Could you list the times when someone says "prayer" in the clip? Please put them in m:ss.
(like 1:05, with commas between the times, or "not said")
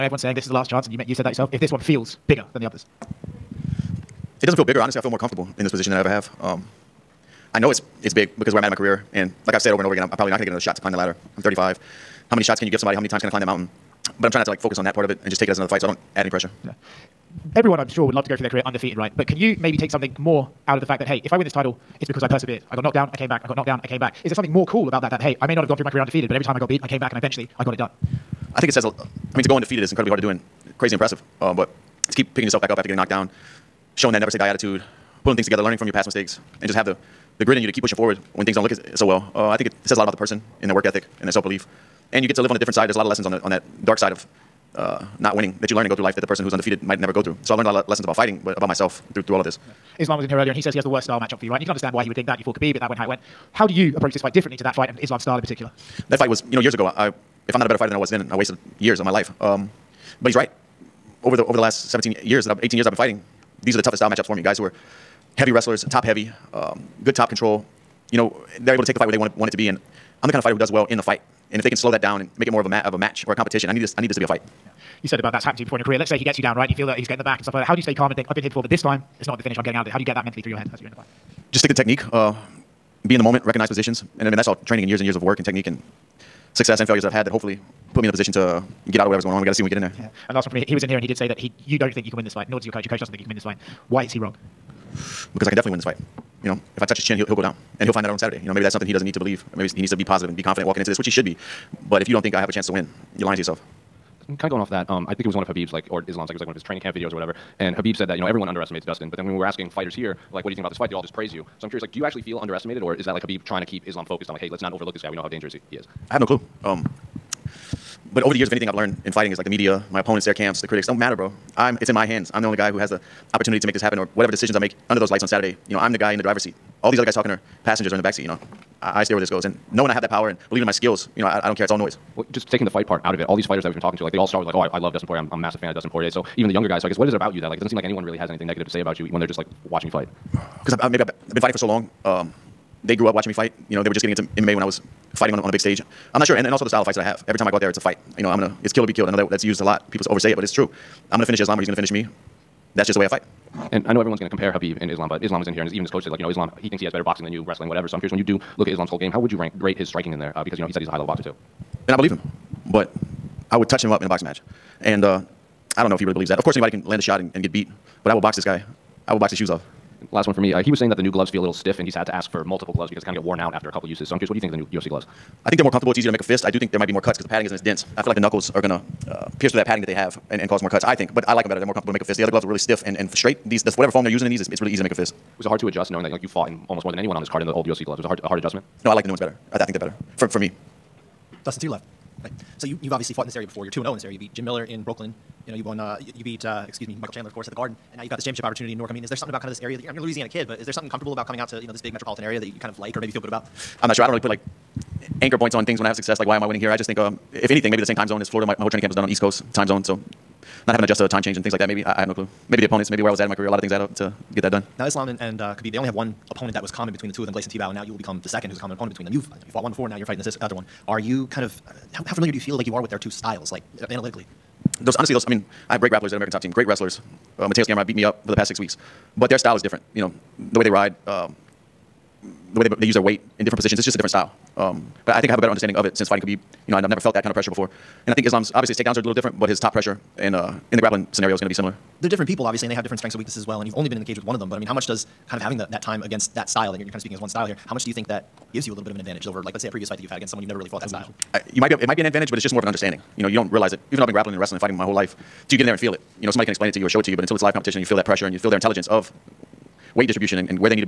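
not said.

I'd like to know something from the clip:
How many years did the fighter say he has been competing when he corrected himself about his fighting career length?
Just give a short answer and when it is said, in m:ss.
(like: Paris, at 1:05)
18 years, at 1:02.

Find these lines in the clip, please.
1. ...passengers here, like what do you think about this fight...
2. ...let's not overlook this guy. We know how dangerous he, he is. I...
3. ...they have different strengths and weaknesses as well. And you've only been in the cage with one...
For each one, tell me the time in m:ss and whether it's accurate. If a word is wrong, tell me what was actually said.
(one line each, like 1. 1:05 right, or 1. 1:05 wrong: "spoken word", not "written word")
1. 1:49 wrong: "fighters", not "passengers"
2. 1:54 right
3. 4:02 right.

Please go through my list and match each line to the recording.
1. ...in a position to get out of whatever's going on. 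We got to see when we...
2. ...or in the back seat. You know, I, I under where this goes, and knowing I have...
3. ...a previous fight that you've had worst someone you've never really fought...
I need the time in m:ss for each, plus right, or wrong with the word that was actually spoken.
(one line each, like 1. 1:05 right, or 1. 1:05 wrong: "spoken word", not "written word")
1. 1:28 right
2. 2:07 wrong: "steer", not "under"
3. 4:09 wrong: "against", not "worst".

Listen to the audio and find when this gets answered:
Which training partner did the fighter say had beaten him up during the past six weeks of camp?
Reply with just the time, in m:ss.
3:47.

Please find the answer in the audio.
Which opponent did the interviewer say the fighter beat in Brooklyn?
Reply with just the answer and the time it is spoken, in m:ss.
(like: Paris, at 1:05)
Jim Miller, at 3:14.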